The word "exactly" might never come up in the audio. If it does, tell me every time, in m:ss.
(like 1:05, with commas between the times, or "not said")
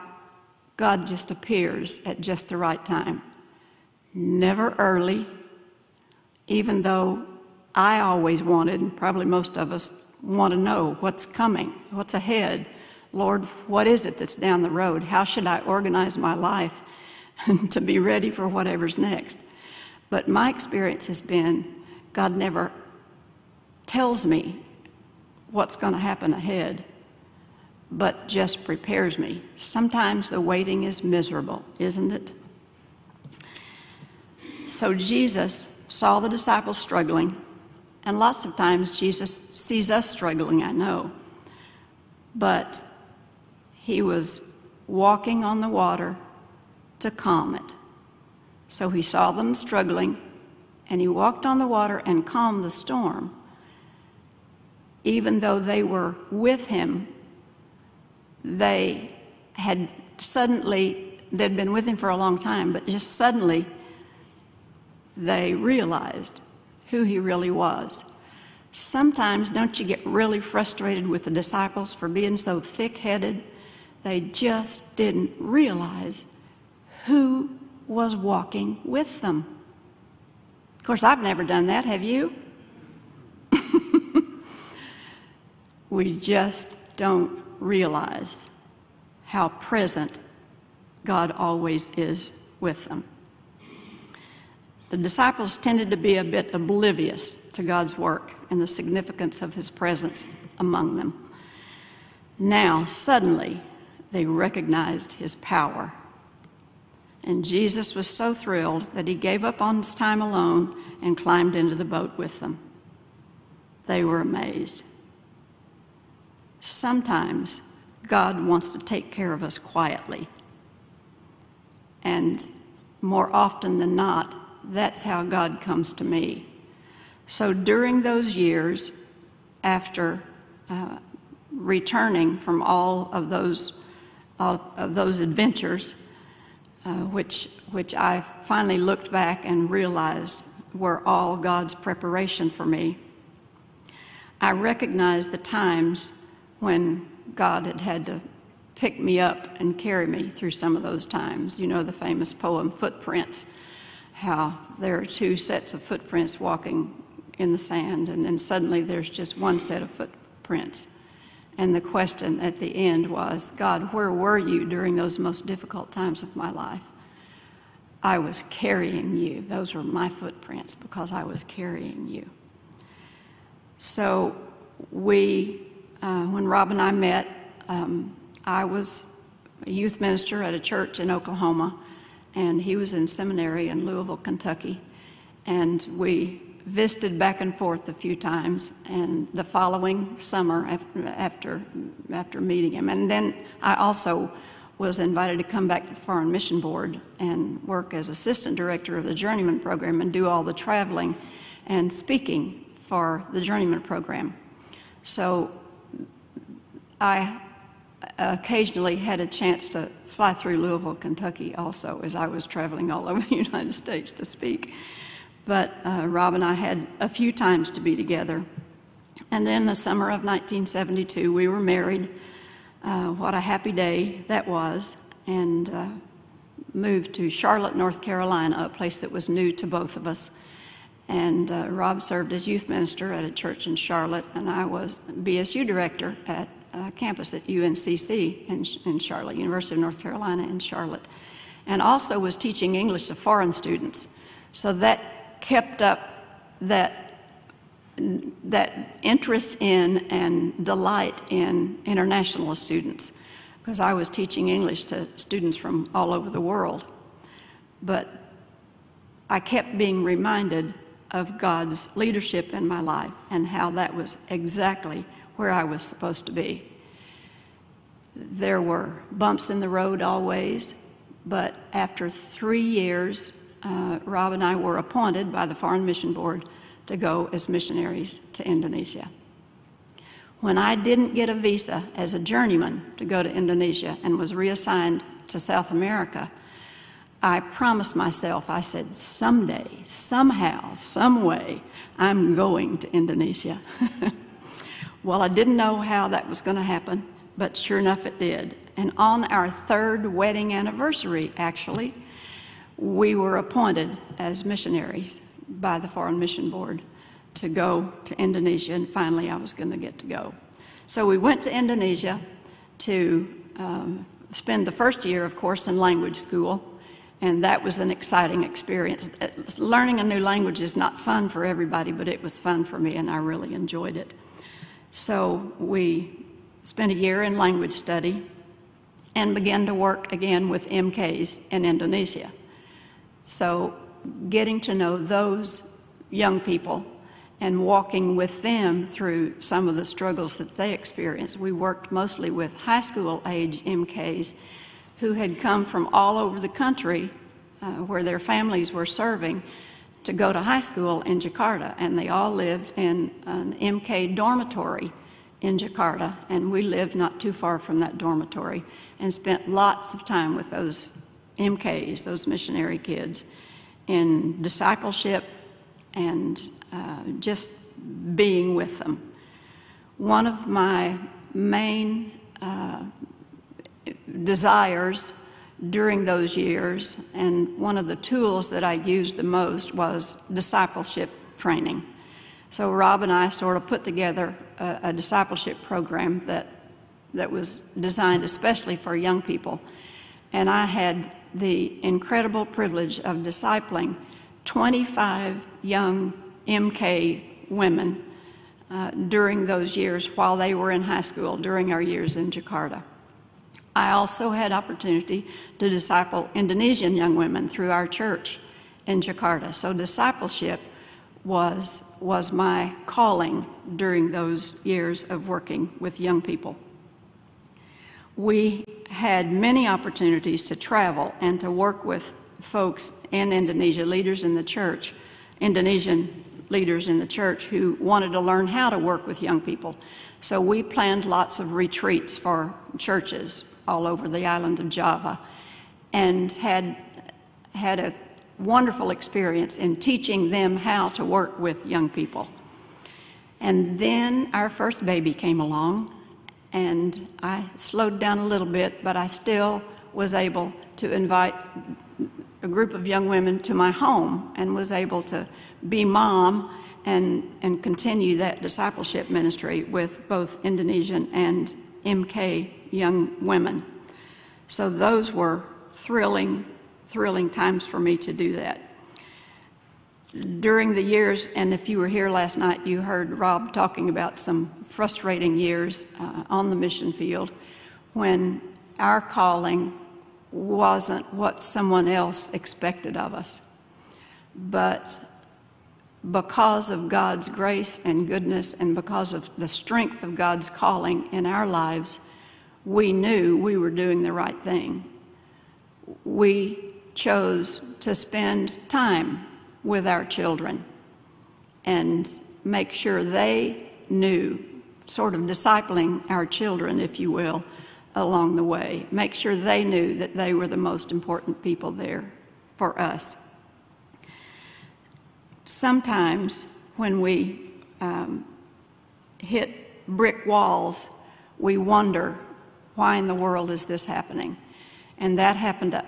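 4:24.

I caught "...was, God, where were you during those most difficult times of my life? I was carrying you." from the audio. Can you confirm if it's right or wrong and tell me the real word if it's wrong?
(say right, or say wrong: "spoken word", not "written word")
right.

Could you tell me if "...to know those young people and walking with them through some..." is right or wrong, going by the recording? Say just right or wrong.
right.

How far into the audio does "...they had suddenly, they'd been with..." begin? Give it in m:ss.
0:58.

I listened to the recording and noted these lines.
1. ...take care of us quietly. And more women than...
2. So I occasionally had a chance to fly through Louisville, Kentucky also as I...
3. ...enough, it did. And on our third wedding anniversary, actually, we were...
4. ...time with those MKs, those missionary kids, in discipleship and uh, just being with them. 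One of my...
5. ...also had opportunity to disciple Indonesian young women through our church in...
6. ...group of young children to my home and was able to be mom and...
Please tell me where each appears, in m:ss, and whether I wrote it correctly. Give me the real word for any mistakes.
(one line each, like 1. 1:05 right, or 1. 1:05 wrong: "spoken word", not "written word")
1. 1:58 wrong: "often", not "women"
2. 3:25 right
3. 4:57 right
4. 6:00 right
5. 6:43 right
6. 7:32 wrong: "women", not "children".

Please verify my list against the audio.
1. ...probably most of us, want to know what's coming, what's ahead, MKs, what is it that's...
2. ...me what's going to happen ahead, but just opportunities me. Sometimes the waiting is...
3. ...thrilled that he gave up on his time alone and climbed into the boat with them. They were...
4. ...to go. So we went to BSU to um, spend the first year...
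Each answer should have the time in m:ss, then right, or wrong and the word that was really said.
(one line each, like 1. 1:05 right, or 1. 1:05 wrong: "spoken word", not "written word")
1. 0:08 wrong: "Lord", not "MKs"
2. 0:24 wrong: "prepares", not "opportunities"
3. 1:48 right
4. 5:09 wrong: "Indonesia", not "BSU".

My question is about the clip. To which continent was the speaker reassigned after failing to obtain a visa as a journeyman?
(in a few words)
South America.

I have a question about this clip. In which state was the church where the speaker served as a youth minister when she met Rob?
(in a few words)
Oklahoma.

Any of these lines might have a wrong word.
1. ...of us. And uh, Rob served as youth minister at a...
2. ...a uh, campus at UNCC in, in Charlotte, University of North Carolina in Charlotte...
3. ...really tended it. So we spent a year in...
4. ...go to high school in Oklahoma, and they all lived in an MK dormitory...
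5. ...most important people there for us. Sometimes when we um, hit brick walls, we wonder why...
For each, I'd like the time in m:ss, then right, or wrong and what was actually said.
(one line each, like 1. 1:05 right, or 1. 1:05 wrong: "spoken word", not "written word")
1. 3:49 right
2. 3:56 right
3. 5:23 wrong: "enjoyed", not "tended"
4. 5:50 wrong: "Jakarta", not "Oklahoma"
5. 8:30 right.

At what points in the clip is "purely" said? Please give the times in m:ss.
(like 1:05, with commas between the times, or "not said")
not said.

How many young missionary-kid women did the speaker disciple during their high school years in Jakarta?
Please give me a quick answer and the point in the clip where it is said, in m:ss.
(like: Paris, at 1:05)
25, at 6:34.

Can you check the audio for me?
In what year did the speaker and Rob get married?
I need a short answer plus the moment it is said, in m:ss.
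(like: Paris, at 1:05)
1972, at 3:40.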